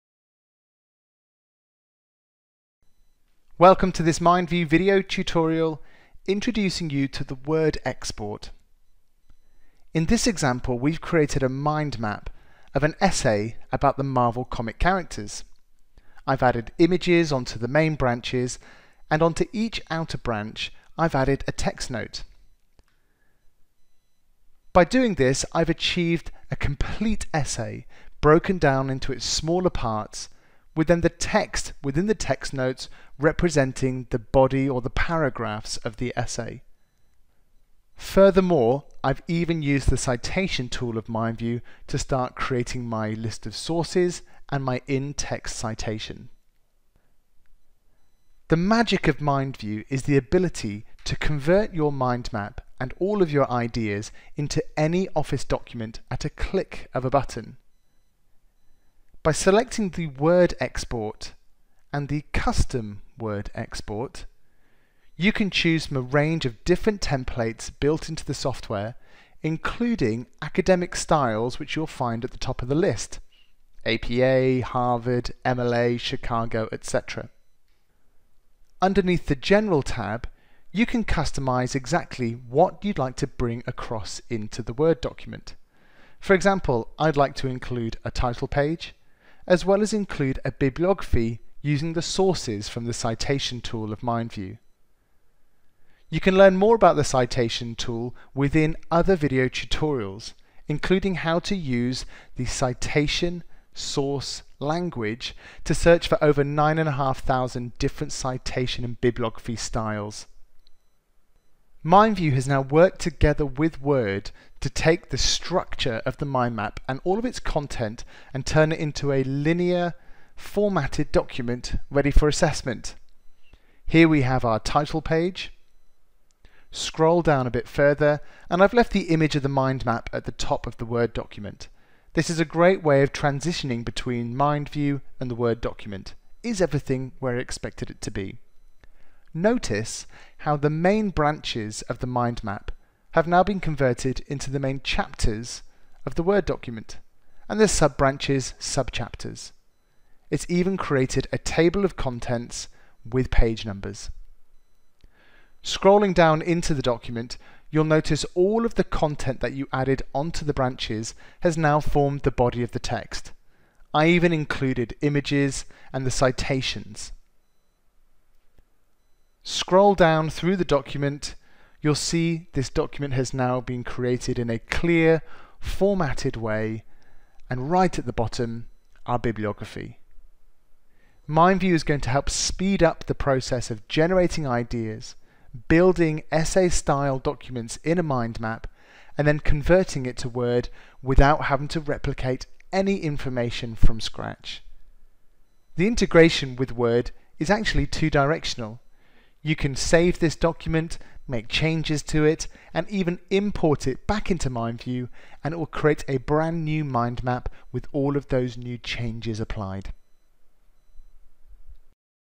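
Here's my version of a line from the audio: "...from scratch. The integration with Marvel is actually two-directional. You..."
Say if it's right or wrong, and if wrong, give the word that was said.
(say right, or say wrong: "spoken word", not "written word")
wrong: "Word", not "Marvel".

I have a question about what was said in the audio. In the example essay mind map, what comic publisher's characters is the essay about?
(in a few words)
Marvel.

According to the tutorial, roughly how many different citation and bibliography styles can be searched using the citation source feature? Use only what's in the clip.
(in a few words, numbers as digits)
9,500.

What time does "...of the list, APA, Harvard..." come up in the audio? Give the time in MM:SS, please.
01:12.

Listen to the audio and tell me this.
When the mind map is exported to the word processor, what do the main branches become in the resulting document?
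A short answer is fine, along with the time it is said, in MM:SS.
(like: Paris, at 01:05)
Main chapters, at 02:24.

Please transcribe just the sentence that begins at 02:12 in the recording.
This is a great way of transitioning between MindView and the Word document.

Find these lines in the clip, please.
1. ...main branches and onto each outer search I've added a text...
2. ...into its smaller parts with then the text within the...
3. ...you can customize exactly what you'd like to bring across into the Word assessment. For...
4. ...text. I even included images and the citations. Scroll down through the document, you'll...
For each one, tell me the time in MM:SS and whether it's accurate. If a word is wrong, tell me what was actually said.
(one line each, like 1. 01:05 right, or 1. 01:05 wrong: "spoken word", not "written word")
1. 00:17 wrong: "branch", not "search"
2. 00:28 right
3. 01:20 wrong: "document", not "assessment"
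4. 02:42 right.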